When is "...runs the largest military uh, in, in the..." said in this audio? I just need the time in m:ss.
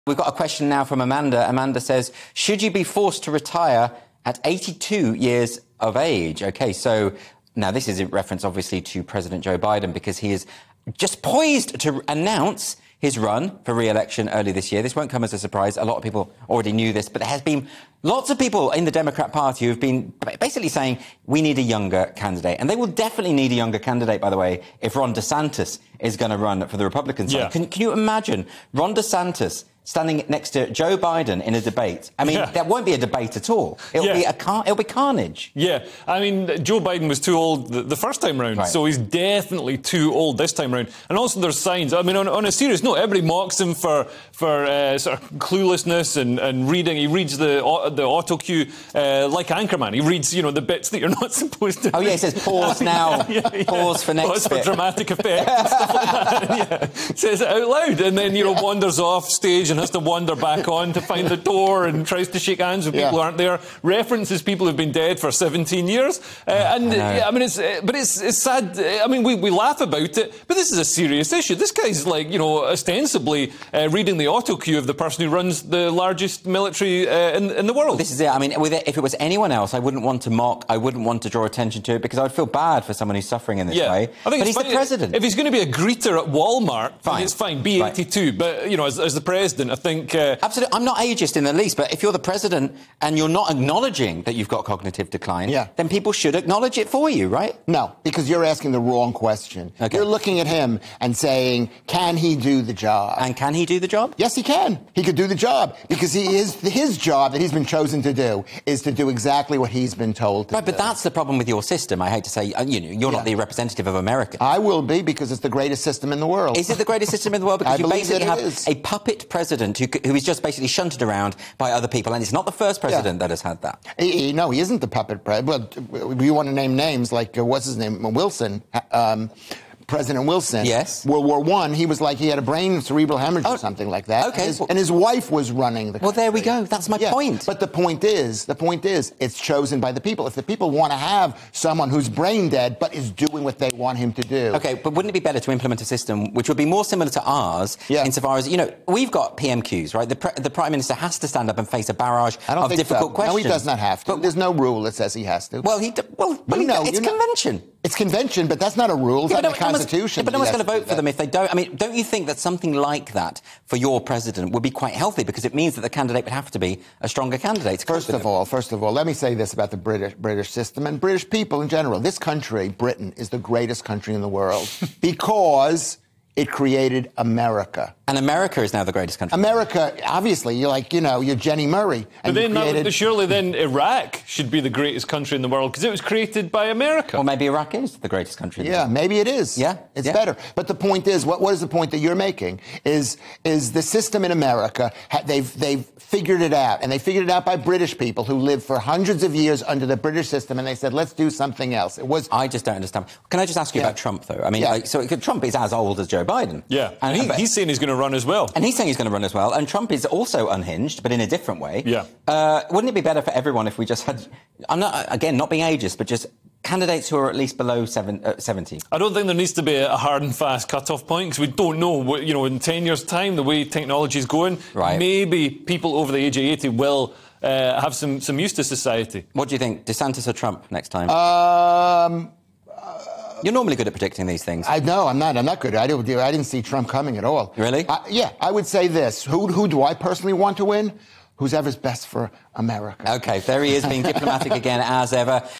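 1:15.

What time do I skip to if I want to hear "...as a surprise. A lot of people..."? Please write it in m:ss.
0:15.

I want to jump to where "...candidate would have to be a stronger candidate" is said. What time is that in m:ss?
2:45.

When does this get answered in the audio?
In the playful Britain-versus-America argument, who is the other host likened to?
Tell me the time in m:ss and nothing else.
3:01.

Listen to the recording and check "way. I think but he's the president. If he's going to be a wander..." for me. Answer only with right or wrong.
wrong.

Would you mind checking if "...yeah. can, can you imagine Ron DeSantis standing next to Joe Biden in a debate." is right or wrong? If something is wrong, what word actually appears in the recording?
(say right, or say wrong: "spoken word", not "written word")
right.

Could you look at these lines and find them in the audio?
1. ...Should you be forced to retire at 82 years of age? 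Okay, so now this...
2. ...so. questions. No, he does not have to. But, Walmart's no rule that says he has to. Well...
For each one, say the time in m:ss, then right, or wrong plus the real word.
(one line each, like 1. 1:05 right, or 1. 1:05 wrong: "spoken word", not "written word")
1. 0:02 right
2. 2:33 wrong: "There", not "Walmart".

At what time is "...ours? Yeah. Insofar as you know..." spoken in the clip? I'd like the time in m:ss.
2:27.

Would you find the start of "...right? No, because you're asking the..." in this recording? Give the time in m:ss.
1:37.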